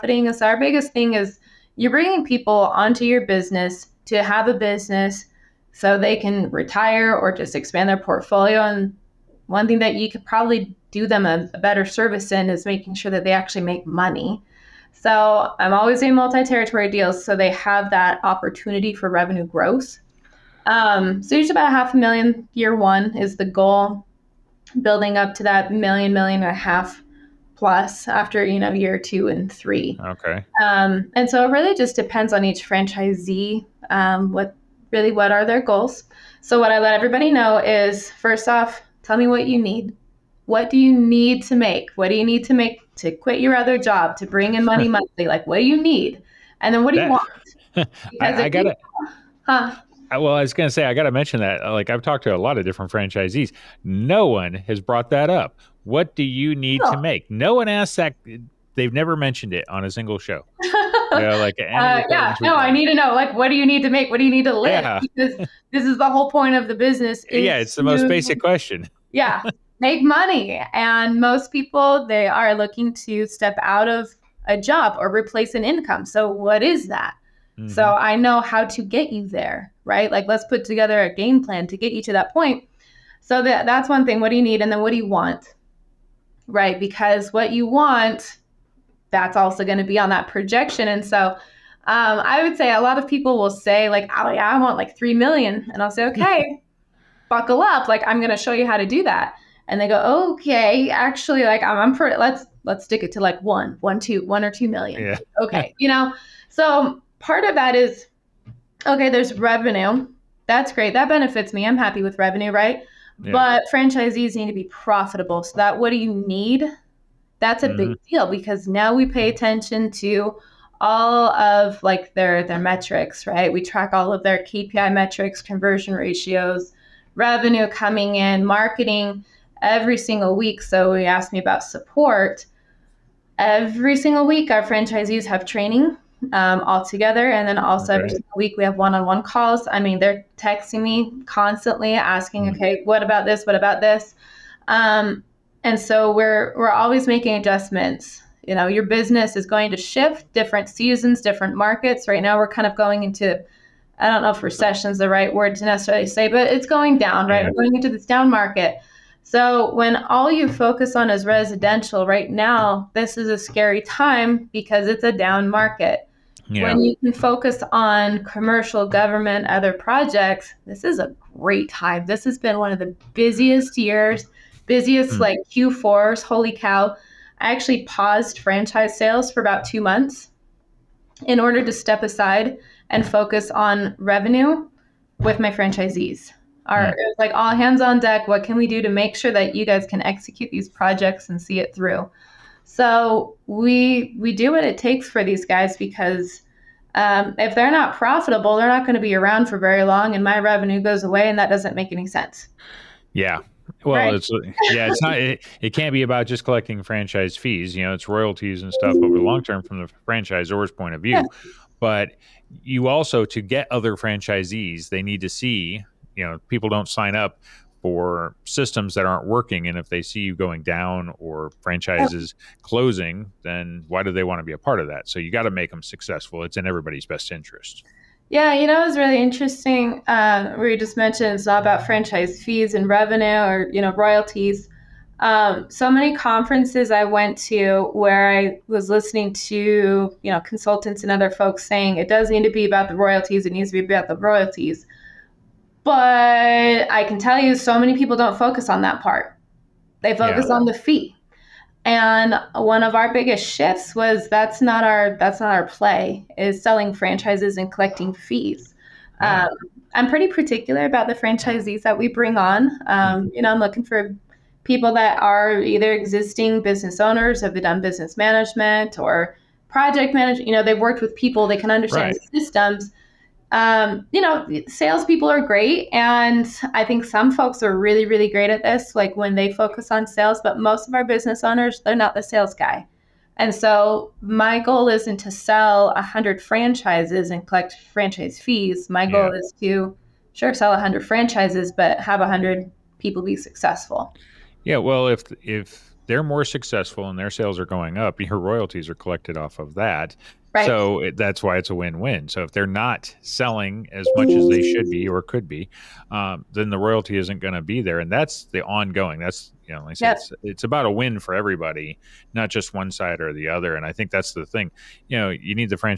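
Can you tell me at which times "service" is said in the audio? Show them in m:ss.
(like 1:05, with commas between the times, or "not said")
0:11.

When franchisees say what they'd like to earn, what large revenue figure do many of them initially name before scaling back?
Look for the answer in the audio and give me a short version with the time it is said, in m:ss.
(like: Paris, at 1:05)
3 million, at 1:34.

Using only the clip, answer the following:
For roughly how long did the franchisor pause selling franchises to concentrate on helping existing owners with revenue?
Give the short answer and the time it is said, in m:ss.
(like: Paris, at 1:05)
about two months, at 2:59.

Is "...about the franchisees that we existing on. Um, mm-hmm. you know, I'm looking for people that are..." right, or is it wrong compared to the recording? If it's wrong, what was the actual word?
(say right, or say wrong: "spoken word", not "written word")
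wrong: "bring", not "existing".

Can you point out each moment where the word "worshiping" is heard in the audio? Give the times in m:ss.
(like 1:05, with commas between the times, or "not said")
not said.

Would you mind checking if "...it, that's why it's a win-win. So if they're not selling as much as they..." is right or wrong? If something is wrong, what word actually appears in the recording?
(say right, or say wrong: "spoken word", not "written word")
right.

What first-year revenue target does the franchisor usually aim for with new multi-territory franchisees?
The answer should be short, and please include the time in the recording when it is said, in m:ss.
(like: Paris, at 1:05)
half a million, at 0:21.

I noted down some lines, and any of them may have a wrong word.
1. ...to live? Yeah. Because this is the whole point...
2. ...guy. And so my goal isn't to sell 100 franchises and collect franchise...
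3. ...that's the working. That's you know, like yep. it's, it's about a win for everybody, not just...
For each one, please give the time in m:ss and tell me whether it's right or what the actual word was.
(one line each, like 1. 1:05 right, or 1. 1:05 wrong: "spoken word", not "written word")
1. 1:04 right
2. 4:42 right
3. 5:08 wrong: "ongoing", not "working".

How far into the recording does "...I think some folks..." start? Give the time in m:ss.
4:36.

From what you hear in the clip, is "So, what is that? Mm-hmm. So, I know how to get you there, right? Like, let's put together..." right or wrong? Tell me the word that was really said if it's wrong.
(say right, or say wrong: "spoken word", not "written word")
right.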